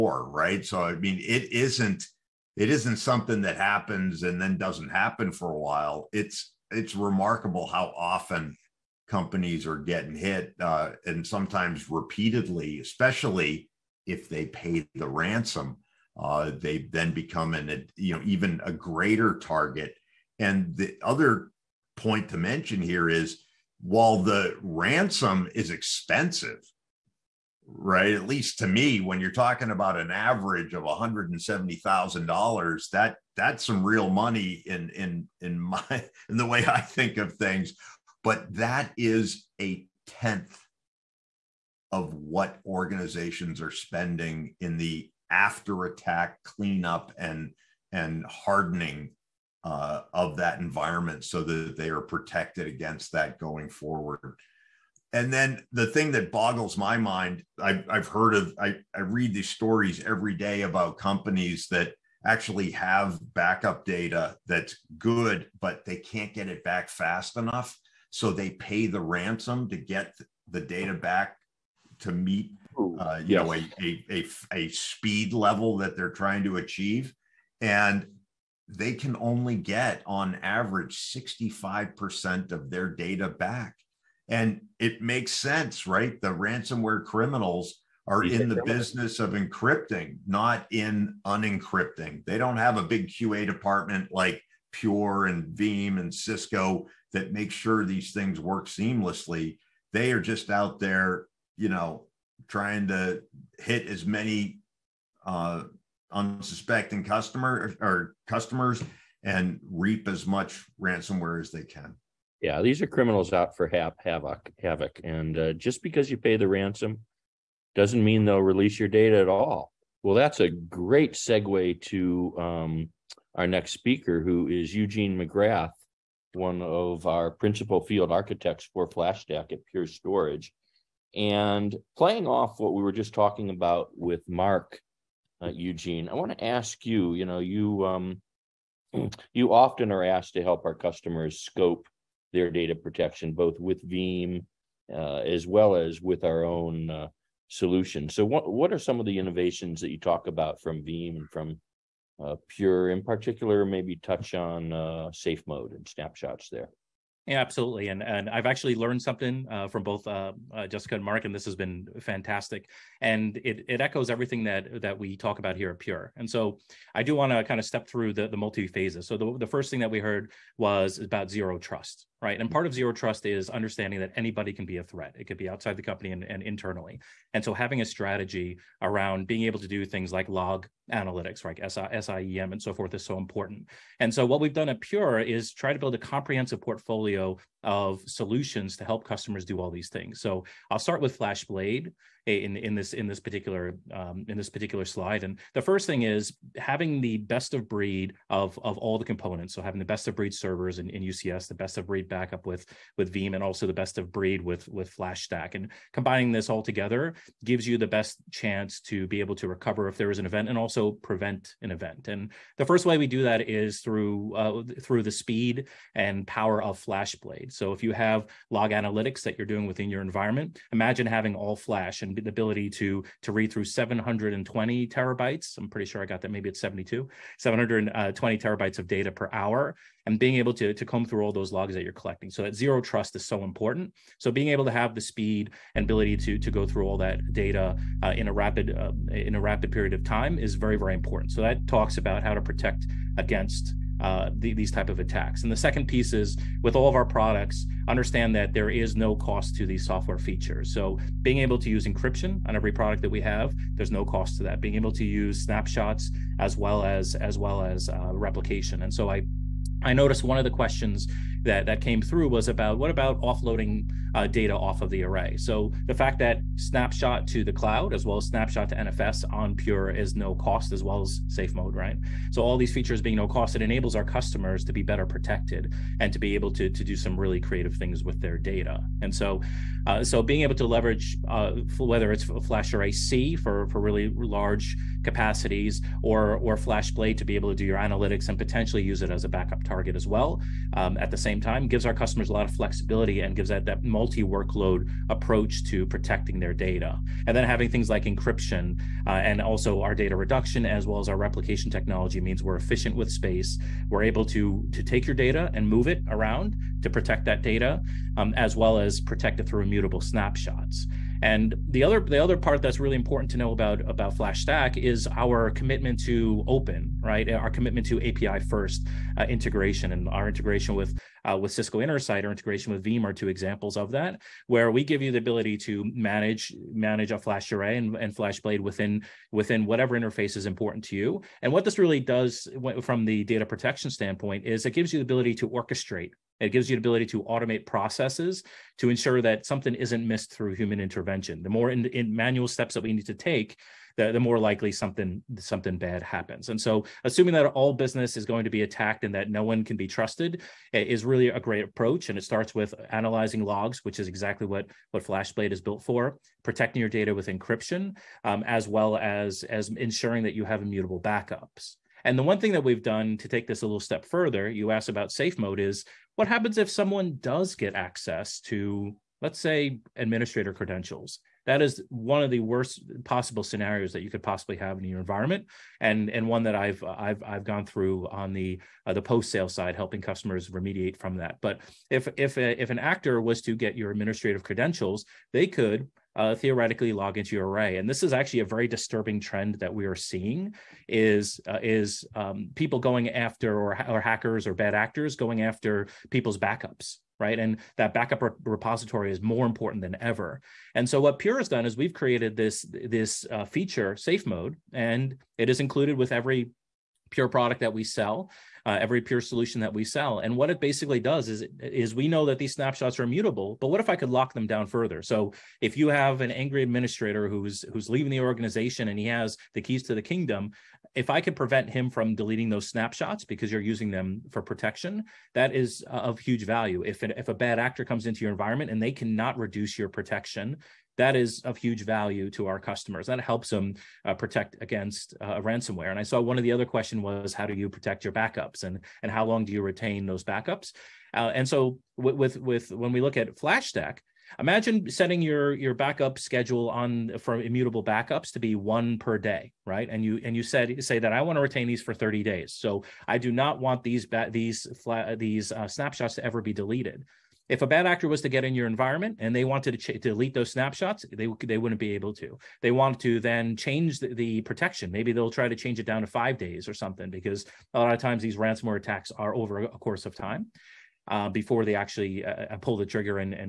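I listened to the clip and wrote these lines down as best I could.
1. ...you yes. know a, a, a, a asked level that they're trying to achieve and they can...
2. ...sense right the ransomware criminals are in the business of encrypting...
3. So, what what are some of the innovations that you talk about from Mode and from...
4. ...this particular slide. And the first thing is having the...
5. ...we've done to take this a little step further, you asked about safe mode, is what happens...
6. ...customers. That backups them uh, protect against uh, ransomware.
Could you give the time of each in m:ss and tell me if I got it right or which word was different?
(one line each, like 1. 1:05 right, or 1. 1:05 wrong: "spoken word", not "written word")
1. 1:13 wrong: "speed", not "asked"
2. 1:25 right
3. 2:28 wrong: "Veeam", not "Mode"
4. 3:14 right
5. 6:02 right
6. 7:12 wrong: "helps", not "backups".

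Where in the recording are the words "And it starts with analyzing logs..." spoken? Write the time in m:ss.
5:52.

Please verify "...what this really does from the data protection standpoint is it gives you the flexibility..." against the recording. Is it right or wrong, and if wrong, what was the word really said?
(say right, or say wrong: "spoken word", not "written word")
wrong: "ability", not "flexibility".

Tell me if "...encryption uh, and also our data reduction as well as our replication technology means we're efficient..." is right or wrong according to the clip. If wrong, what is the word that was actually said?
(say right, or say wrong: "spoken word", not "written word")
right.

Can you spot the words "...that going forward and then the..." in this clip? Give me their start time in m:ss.
0:53.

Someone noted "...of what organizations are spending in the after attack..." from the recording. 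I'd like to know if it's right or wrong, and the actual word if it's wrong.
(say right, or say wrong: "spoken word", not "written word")
right.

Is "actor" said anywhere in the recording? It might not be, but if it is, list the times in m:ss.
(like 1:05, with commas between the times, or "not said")
6:22, 6:34, 7:07, 7:37.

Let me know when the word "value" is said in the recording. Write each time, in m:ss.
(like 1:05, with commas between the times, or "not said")
7:06, 7:11.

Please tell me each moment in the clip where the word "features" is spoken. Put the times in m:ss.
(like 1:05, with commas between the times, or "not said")
4:10, 4:32, 6:43.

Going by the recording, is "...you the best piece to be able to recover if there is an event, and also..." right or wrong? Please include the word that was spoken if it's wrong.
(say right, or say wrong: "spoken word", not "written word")
wrong: "chance", not "piece".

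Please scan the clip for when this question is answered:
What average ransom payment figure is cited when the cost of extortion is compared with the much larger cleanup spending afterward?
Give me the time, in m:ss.
0:30.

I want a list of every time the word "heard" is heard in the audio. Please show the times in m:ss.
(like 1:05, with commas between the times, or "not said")
0:58, 2:49.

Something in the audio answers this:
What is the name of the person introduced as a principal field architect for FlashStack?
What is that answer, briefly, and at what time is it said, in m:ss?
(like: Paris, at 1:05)
Eugene McGrath, at 2:04.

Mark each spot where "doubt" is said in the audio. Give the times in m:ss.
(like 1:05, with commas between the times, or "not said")
not said.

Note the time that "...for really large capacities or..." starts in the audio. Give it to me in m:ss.
4:43.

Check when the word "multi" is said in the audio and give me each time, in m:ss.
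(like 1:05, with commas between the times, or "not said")
2:48, 4:53.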